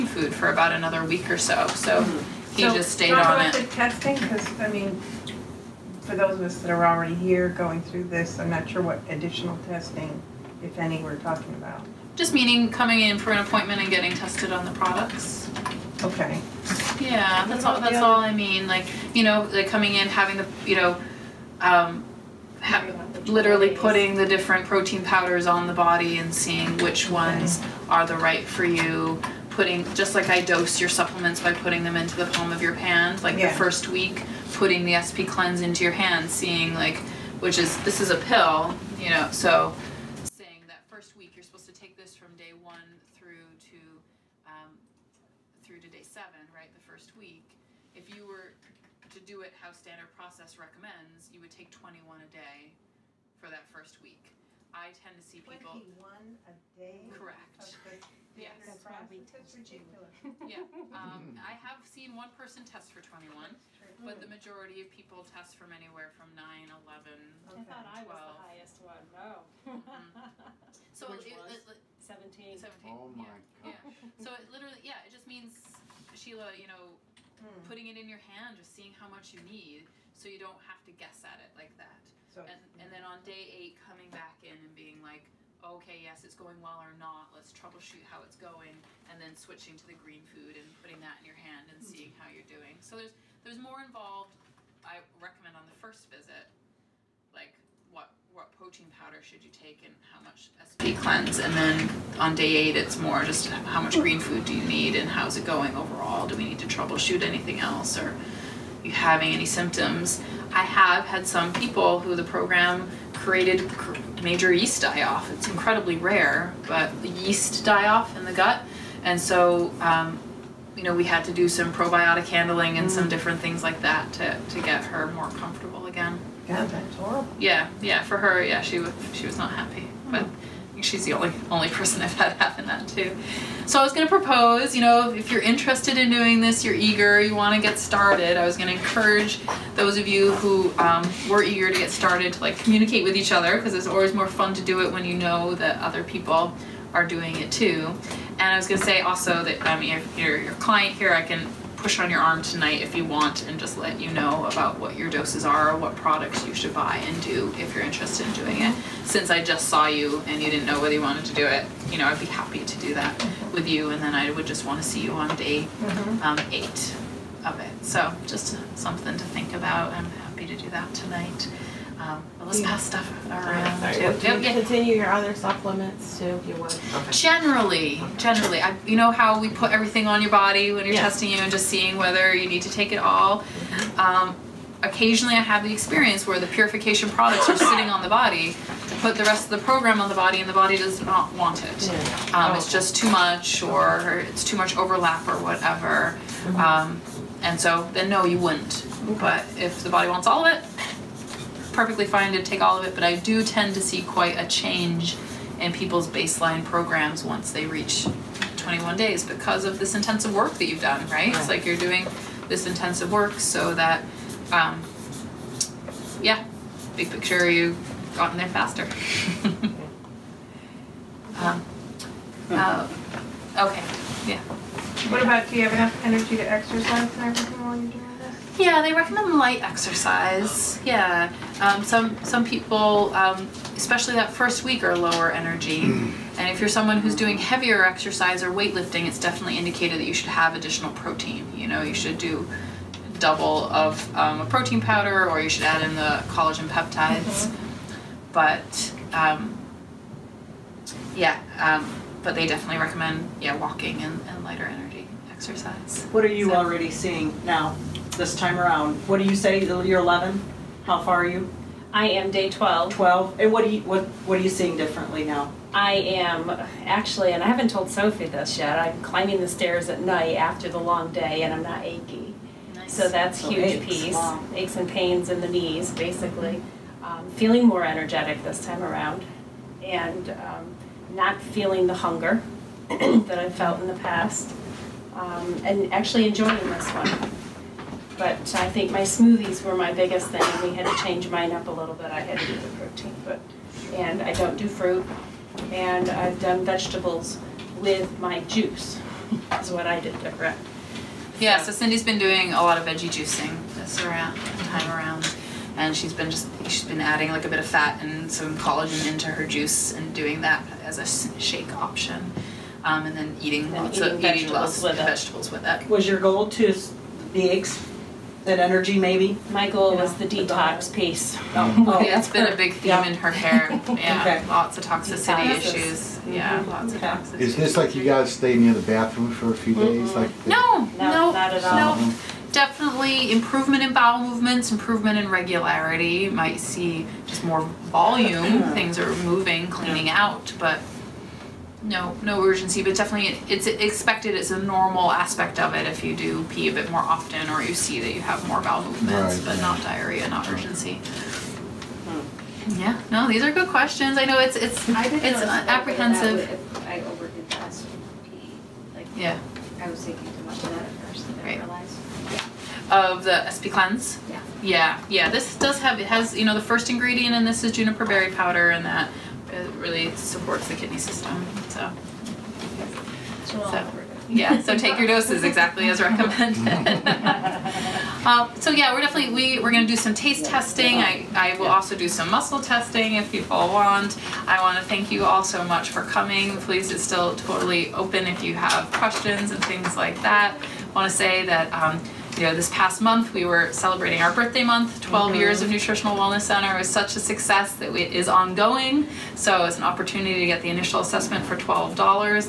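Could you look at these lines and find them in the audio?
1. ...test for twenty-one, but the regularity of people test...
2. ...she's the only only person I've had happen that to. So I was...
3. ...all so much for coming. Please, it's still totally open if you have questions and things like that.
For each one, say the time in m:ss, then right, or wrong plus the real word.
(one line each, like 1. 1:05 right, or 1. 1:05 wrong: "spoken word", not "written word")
1. 1:02 wrong: "majority", not "regularity"
2. 2:10 right
3. 6:25 right.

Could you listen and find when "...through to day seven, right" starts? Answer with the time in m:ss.
0:45.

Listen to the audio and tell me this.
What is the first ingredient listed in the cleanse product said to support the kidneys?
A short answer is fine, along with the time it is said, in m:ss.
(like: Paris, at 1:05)
juniper berry powder, at 6:07.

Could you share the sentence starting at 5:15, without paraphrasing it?
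Was your goal to the eggs that energy maybe?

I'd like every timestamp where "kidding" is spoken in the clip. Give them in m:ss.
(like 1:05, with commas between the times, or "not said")
not said.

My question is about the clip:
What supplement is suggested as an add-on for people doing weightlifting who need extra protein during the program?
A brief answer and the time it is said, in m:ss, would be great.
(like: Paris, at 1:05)
collagen peptides, at 4:06.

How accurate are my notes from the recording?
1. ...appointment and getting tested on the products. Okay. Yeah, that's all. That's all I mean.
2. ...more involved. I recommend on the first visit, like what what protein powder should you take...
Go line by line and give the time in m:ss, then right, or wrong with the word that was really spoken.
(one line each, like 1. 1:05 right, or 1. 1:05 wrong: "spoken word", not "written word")
1. 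0:13 right
2. 1:33 right.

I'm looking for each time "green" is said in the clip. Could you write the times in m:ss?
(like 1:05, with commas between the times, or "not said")
1:29, 1:44.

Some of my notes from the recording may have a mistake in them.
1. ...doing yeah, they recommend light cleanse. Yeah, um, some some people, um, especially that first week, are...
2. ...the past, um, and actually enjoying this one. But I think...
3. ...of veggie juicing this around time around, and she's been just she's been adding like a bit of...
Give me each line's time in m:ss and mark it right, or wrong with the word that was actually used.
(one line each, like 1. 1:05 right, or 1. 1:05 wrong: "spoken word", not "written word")
1. 3:47 wrong: "exercise", not "cleanse"
2. 4:43 right
3. 5:02 right.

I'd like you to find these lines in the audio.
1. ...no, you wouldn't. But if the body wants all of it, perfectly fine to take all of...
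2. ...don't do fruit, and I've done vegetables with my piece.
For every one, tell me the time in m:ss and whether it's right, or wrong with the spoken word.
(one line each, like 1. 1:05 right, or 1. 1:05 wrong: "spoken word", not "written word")
1. 3:18 right
2. 4:54 wrong: "juice", not "piece".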